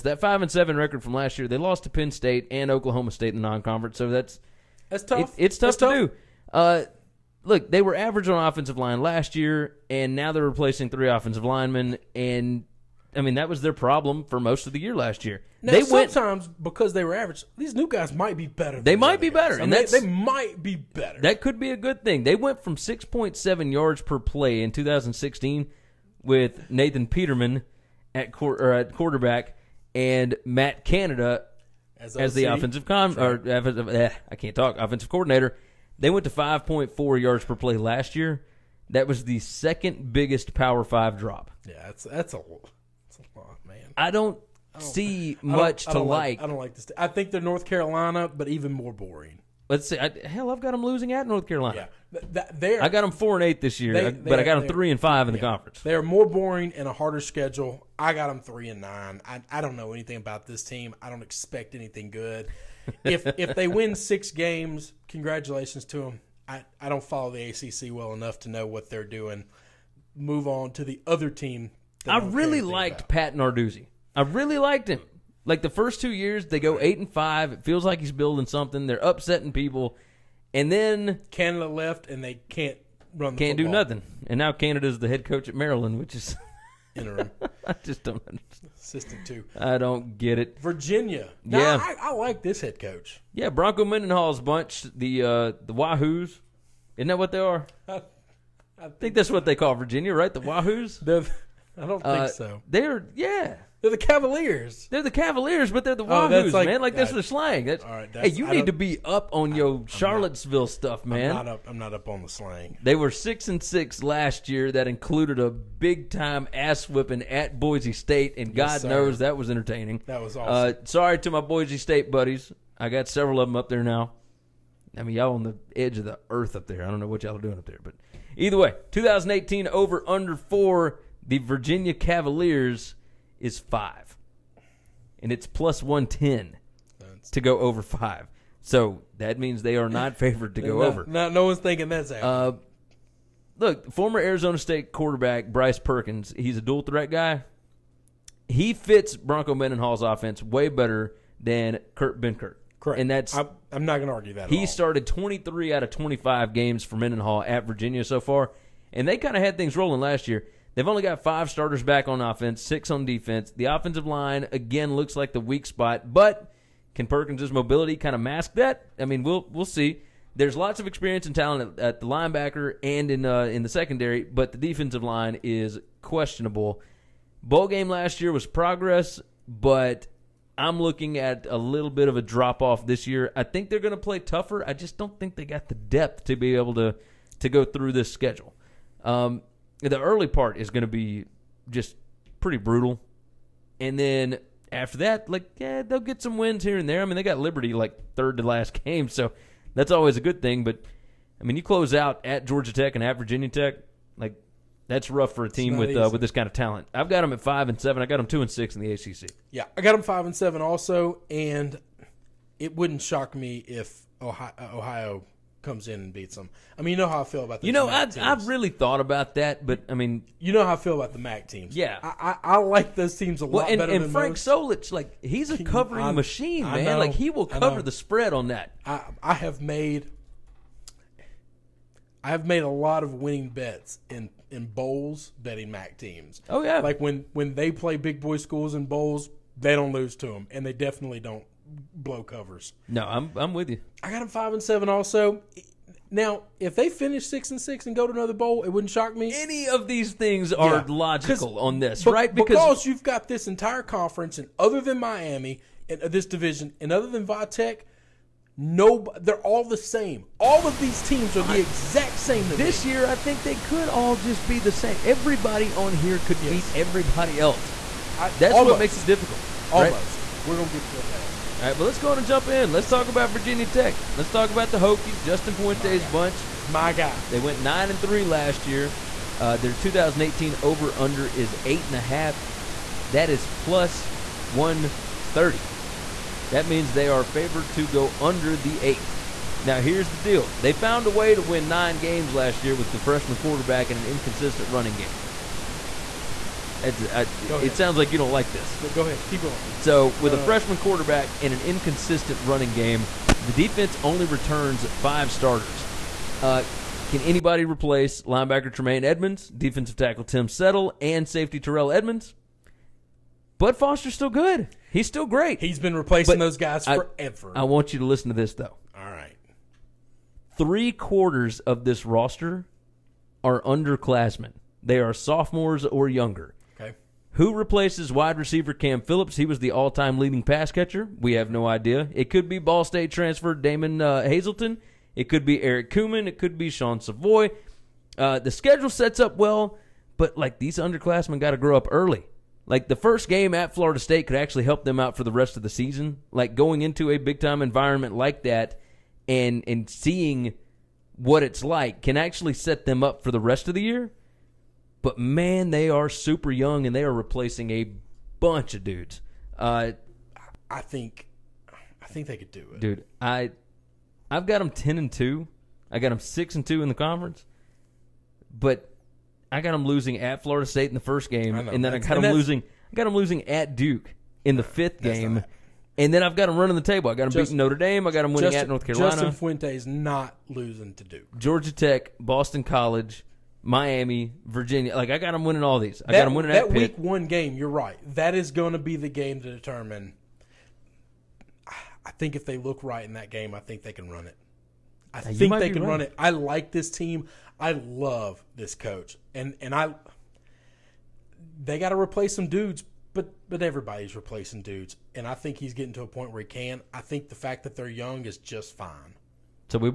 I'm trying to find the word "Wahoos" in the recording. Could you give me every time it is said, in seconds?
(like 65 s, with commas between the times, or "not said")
95 s, 100 s, 106 s.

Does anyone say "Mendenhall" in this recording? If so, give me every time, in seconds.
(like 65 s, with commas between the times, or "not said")
93 s, 149 s, 156 s.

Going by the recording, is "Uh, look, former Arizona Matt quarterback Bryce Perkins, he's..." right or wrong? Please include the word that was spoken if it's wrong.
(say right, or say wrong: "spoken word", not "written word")
wrong: "State", not "Matt".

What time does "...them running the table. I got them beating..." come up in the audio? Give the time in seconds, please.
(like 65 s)
376 s.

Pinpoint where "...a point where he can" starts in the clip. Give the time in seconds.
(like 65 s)
406 s.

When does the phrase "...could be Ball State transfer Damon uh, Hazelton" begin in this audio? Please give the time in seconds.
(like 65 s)
332 s.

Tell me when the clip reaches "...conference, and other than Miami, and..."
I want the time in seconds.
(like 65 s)
253 s.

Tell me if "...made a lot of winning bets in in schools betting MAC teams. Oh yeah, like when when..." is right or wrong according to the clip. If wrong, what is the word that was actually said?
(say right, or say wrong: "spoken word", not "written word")
wrong: "bowls", not "schools".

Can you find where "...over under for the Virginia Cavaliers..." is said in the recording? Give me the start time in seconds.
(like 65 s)
129 s.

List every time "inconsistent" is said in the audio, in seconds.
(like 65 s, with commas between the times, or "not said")
294 s, 301 s.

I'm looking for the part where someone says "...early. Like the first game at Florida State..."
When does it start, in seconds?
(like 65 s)
341 s.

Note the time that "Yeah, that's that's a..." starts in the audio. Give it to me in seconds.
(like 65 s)
41 s.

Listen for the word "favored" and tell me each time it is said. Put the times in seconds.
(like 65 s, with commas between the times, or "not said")
140 s, 287 s.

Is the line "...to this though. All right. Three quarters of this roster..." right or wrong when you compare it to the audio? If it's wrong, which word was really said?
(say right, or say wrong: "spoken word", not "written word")
right.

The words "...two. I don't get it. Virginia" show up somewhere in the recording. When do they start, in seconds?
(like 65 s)
89 s.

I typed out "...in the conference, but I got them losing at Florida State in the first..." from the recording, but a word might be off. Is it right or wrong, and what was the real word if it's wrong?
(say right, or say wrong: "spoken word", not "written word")
right.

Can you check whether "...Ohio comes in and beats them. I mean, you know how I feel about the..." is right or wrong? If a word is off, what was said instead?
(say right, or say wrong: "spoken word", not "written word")
right.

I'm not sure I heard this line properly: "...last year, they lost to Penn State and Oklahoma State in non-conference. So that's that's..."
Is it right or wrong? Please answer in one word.
right.